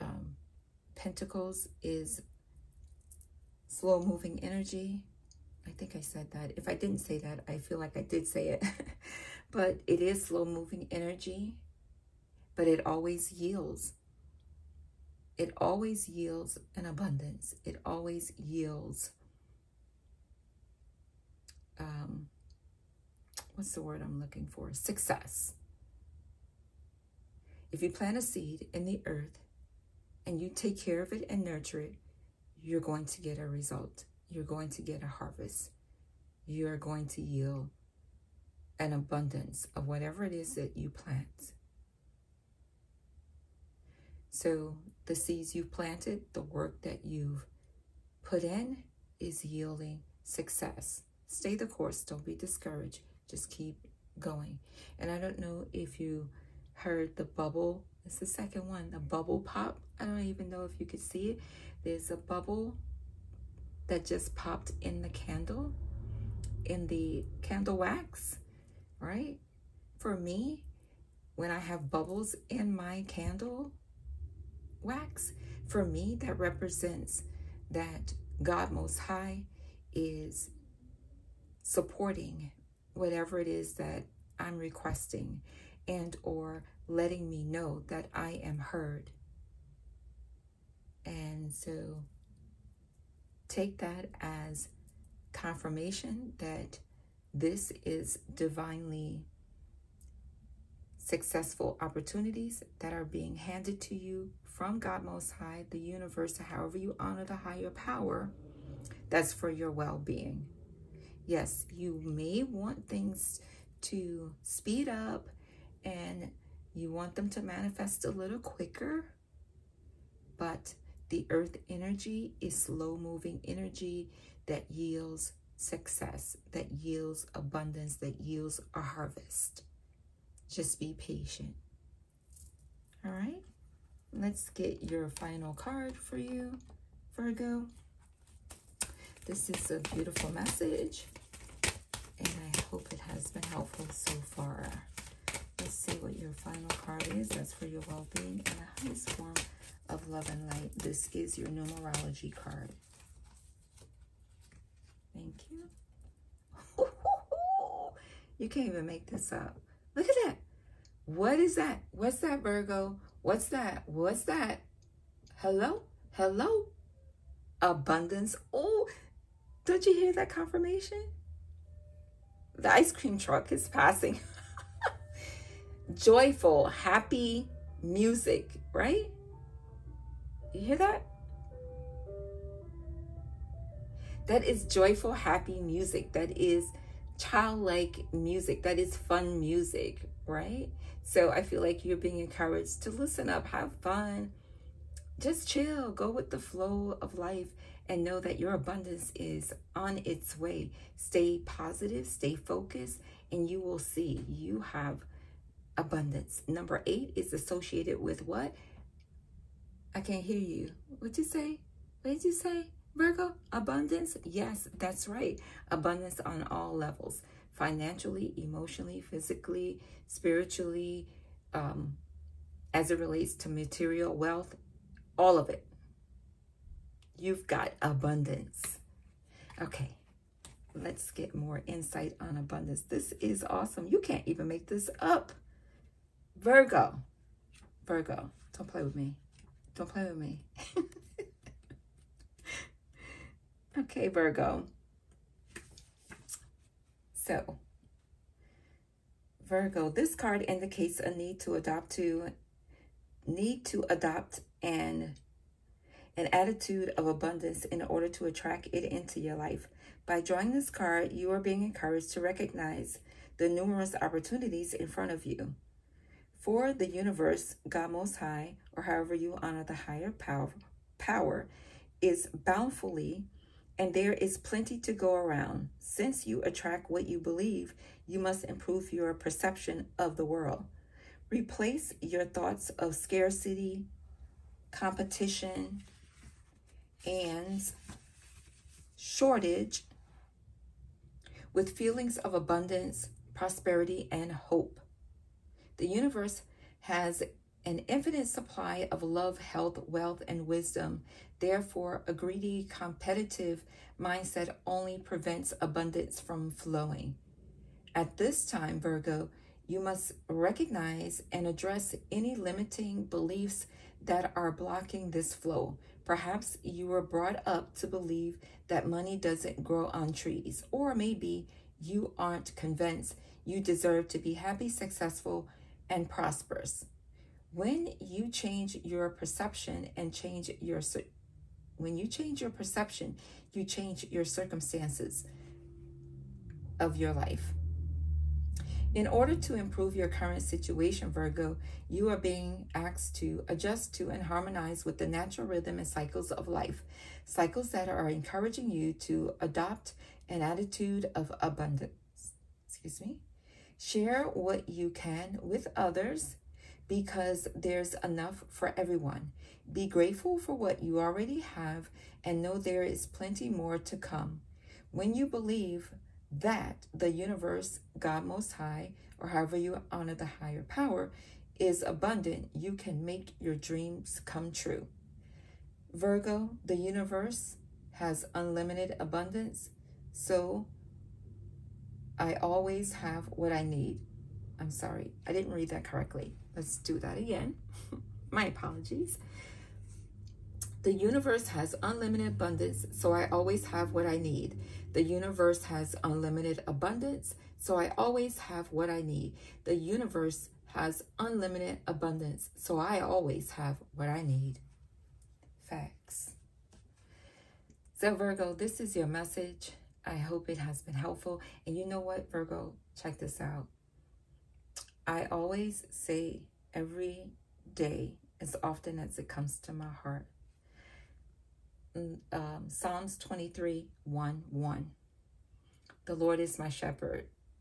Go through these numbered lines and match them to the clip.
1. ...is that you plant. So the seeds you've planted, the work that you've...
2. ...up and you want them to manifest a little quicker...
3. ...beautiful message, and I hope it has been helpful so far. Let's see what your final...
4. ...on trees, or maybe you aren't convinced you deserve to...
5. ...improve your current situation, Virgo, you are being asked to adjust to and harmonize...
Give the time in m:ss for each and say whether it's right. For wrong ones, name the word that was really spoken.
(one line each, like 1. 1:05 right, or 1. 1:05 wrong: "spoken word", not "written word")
1. 0:40 right
2. 1:54 right
3. 2:19 right
4. 5:19 right
5. 5:39 right.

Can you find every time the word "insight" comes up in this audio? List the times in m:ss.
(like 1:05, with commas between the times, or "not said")
3:51.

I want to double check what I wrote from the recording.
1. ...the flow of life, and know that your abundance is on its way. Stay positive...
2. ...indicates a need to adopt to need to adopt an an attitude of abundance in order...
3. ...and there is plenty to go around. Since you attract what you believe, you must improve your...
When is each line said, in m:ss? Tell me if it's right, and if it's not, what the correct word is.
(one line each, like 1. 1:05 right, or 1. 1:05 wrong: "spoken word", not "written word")
1. 3:16 right
2. 4:10 right
3. 4:33 right.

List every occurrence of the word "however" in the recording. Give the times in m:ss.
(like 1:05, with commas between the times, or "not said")
1:46, 4:28, 6:09.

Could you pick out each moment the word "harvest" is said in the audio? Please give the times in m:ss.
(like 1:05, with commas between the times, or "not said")
0:35, 2:08.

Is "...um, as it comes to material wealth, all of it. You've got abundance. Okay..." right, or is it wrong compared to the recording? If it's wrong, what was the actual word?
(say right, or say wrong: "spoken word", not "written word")
wrong: "relates", not "comes".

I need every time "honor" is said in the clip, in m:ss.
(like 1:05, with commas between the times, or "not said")
1:46, 4:29, 6:09.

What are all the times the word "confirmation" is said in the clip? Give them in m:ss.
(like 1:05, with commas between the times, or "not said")
1:35, 2:50.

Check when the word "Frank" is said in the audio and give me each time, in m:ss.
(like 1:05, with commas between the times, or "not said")
not said.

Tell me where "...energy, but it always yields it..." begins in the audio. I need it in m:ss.
0:10.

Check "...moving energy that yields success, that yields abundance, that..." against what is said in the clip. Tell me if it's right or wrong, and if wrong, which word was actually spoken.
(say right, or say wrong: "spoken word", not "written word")
right.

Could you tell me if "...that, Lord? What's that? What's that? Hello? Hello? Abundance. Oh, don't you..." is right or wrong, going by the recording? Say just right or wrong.
wrong.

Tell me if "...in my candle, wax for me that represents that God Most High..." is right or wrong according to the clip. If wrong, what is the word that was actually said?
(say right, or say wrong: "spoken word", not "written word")
right.